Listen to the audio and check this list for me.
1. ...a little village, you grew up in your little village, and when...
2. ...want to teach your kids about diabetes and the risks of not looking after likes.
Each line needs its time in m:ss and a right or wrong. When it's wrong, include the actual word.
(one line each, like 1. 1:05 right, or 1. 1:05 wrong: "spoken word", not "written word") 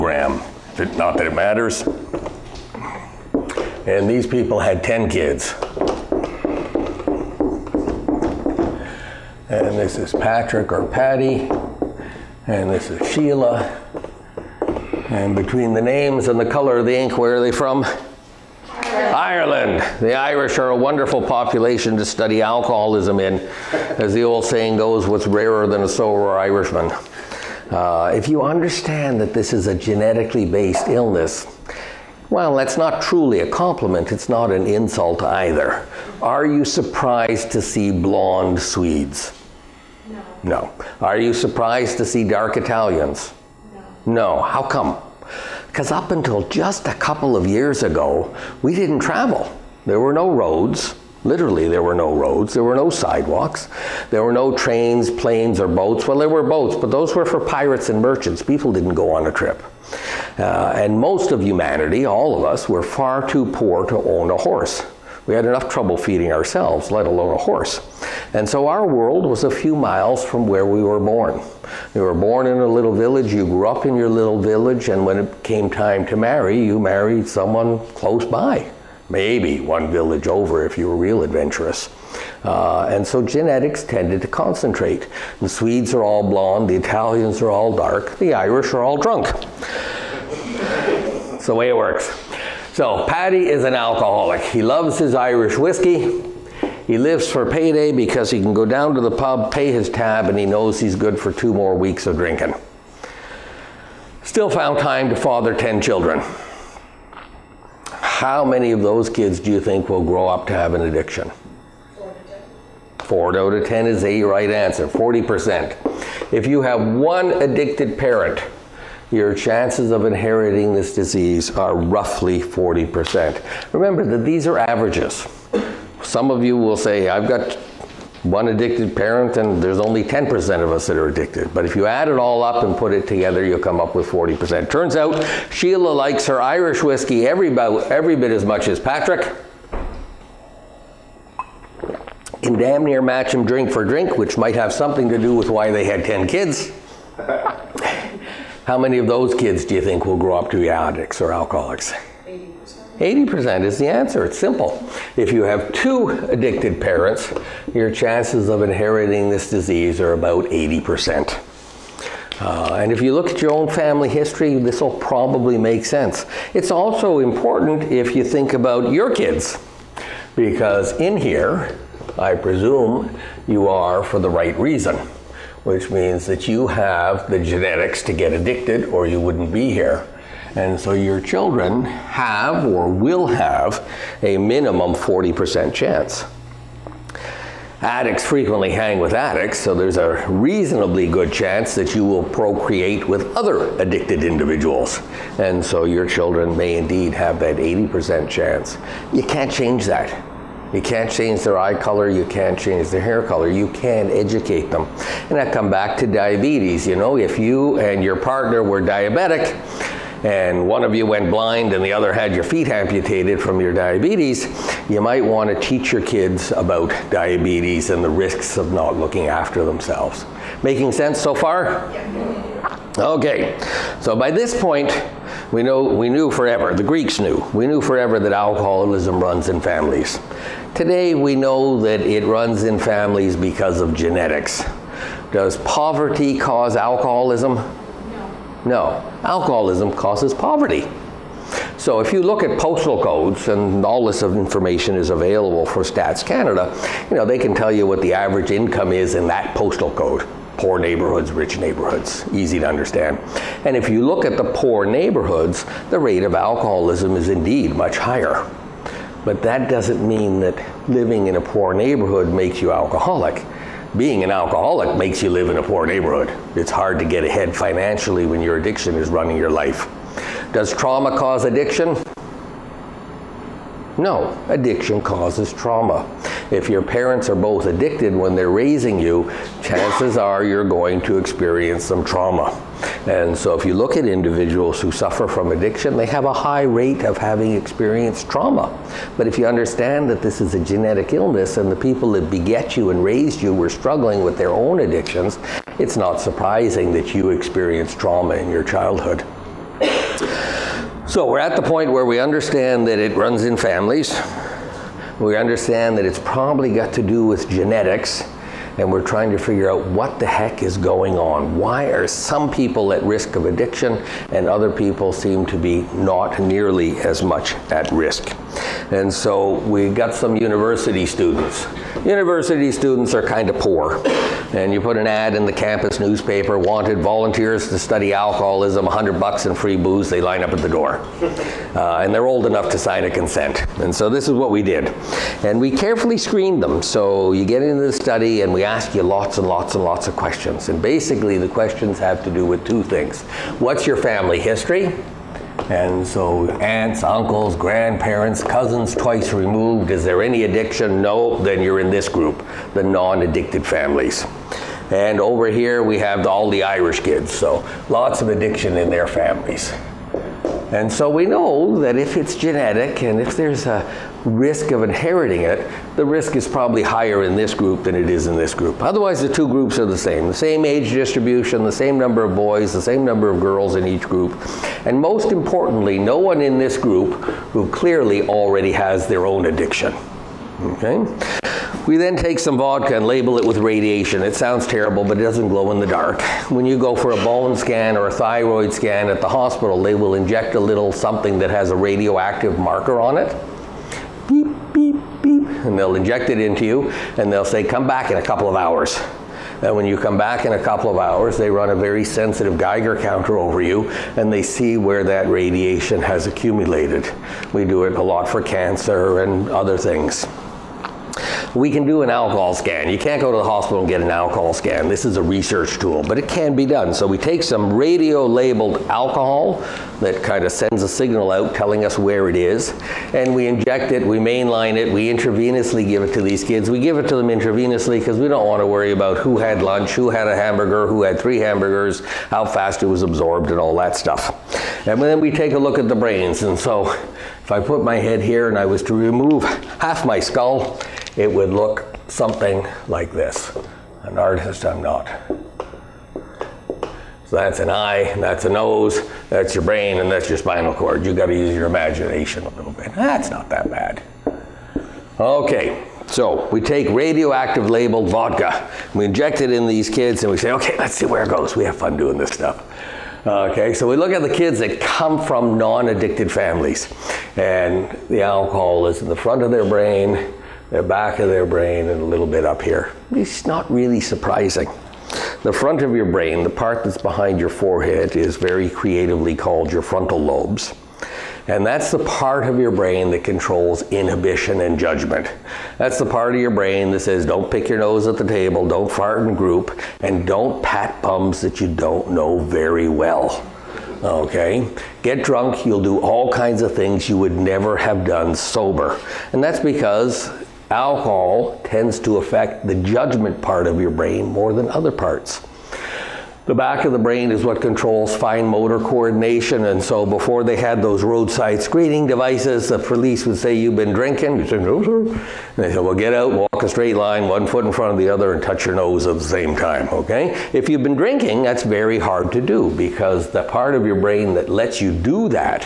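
1. 1:12 right
2. 3:35 wrong: "themselves", not "likes".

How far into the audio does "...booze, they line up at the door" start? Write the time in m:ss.
5:29.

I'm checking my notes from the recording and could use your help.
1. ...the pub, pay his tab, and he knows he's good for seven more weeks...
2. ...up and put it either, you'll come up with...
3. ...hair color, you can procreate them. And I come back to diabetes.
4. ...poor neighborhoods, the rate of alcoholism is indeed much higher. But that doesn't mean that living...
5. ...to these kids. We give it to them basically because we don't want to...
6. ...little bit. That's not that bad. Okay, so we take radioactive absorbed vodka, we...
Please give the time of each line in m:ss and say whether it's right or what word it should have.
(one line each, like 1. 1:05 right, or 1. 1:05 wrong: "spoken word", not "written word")
1. 1:39 wrong: "two", not "seven"
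2. 2:12 wrong: "together", not "either"
3. 3:23 wrong: "educate", not "procreate"
4. 4:14 right
5. 7:06 wrong: "intravenously", not "basically"
6. 7:32 wrong: "labeled", not "absorbed".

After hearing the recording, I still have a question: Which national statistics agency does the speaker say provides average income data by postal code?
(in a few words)
Stats Canada.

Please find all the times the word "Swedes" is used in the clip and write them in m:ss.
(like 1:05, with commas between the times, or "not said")
0:38, 1:25.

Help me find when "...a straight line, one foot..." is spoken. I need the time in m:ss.
8:36.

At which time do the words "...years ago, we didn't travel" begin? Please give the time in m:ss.
0:47.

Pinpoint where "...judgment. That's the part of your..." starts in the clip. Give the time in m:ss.
8:04.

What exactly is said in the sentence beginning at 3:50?
Today we know that it runs in families because of genetics.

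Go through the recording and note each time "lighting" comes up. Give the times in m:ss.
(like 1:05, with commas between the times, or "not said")
not said.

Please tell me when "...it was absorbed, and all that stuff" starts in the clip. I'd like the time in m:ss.
7:12.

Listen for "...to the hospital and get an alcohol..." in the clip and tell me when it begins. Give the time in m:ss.
6:53.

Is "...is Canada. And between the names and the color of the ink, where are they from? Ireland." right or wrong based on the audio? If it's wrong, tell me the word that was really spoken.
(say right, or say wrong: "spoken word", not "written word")
wrong: "Sheila", not "Canada".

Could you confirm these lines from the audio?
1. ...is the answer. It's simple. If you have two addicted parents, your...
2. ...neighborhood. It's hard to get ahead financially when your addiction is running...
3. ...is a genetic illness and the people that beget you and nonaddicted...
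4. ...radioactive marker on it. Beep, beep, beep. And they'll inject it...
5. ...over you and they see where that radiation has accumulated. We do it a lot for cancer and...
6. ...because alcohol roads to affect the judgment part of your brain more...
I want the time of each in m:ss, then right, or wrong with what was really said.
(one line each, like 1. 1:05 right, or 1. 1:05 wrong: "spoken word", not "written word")
1. 2:33 right
2. 4:25 right
3. 4:50 wrong: "raised", not "nonaddicted"
4. 6:31 right
5. 6:43 right
6. 8:19 wrong: "tends", not "roads".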